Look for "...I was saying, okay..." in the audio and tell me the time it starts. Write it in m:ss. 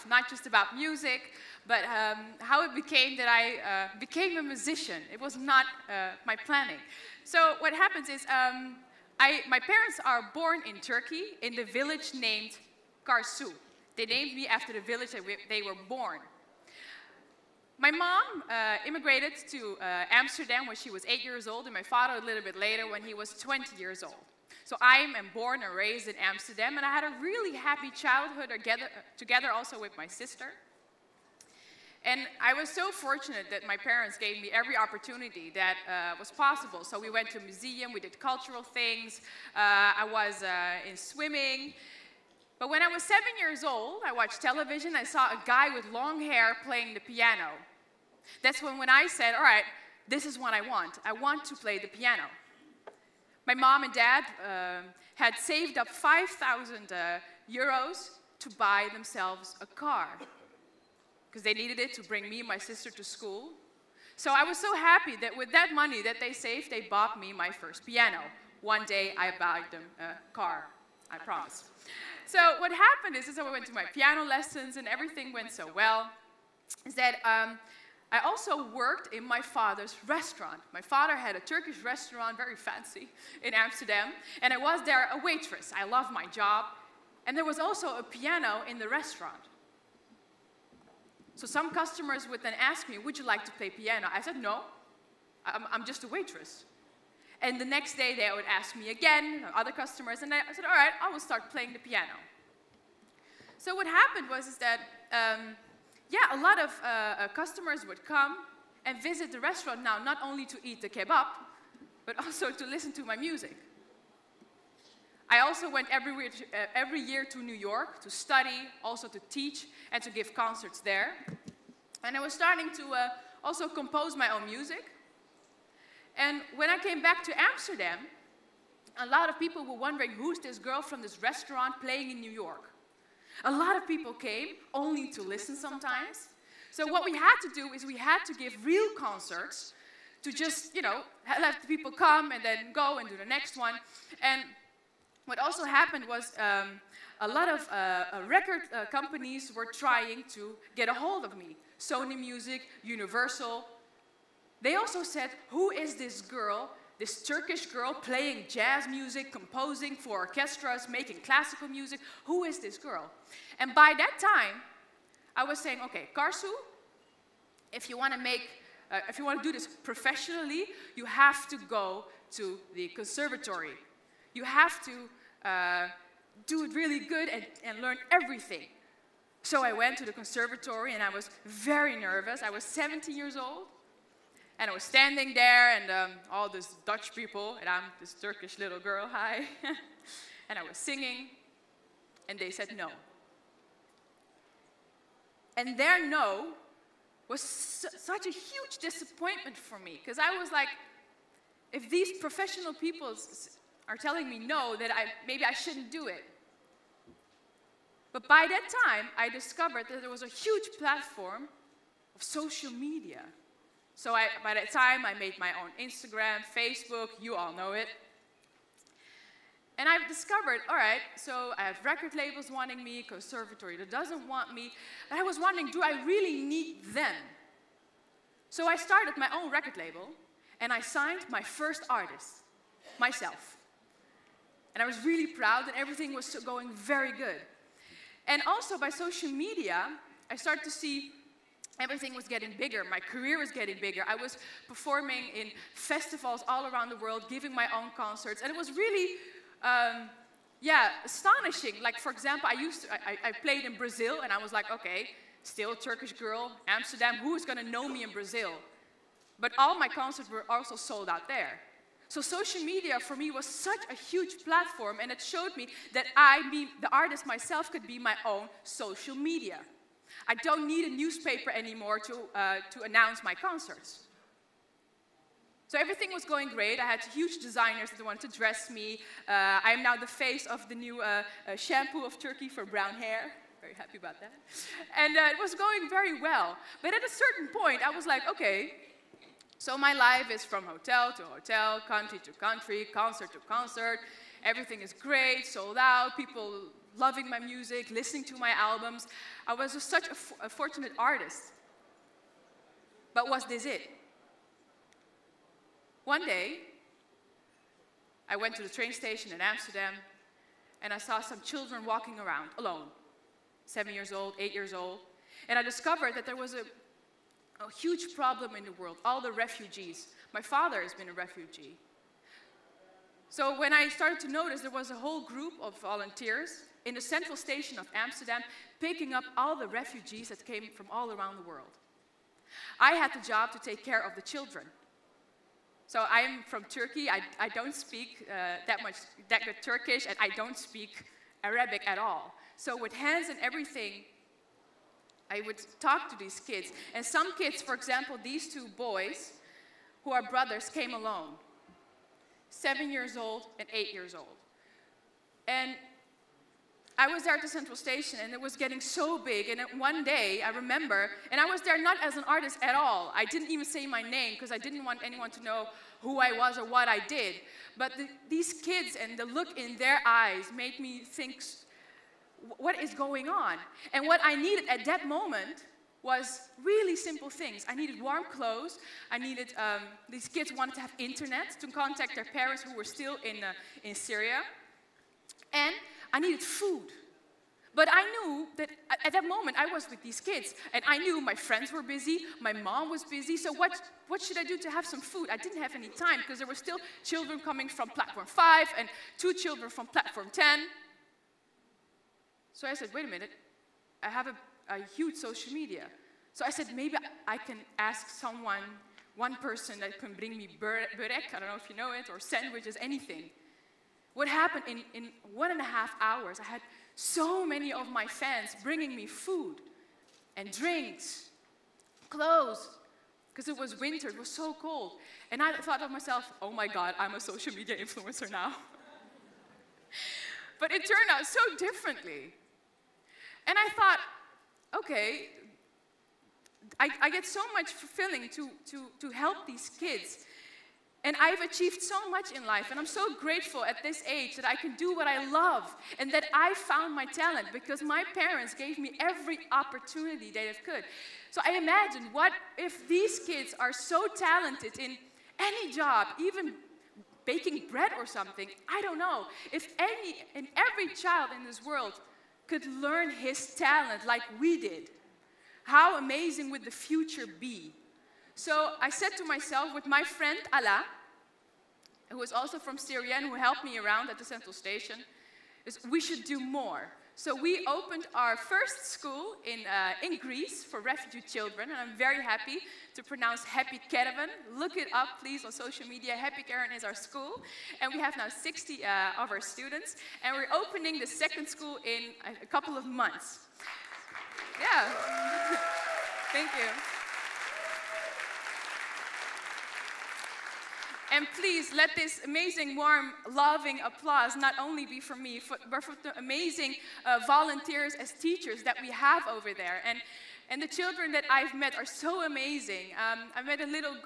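2:45.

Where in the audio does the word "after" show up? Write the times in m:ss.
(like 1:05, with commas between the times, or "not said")
0:14.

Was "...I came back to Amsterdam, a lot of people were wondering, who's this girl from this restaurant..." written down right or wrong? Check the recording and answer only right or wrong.
right.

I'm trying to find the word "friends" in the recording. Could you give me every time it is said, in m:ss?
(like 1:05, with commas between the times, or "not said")
6:31, 7:50.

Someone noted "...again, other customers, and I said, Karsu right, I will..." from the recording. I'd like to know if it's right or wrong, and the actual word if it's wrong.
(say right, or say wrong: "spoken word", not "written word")
wrong: "All", not "Karsu".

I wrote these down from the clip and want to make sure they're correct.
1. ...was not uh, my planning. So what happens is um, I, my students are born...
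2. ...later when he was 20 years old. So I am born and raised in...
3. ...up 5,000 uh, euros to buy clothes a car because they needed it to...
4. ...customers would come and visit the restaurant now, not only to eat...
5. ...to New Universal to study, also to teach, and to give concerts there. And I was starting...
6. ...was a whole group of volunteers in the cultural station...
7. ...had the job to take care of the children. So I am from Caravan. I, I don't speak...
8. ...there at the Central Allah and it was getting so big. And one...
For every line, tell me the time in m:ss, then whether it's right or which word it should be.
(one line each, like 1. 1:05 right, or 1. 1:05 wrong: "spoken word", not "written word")
1. 0:05 wrong: "parents", not "students"
2. 0:22 right
3. 0:55 wrong: "themselves", not "clothes"
4. 1:47 right
5. 1:57 wrong: "York", not "Universal"
6. 5:24 wrong: "central", not "cultural"
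7. 5:32 wrong: "Turkey", not "Caravan"
8. 5:57 wrong: "Station", not "Allah".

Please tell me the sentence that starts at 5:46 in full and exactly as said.
And some kids, for example, these two boys, who are brothers, came alone.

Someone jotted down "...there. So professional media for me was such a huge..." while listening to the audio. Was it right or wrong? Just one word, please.
wrong.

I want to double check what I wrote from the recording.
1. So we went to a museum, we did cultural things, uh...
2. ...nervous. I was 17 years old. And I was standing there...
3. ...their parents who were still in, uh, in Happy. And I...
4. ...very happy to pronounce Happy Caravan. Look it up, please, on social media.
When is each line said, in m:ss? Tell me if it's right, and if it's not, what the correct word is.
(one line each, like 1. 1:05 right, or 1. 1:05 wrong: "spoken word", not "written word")
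1. 0:36 right
2. 3:01 right
3. 6:22 wrong: "Syria", not "Happy"
4. 8:01 right.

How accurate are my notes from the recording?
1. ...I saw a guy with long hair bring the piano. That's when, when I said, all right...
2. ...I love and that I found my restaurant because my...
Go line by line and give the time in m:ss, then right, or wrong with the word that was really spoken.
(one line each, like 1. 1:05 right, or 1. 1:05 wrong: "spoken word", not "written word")
1. 0:44 wrong: "playing", not "bring"
2. 7:25 wrong: "talent", not "restaurant".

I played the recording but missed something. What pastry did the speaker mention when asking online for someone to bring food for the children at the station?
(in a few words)
Burek.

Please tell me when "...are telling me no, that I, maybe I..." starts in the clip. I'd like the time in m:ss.
3:23.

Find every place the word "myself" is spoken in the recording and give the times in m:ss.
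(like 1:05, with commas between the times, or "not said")
3:52, 4:27, 7:05, 7:49.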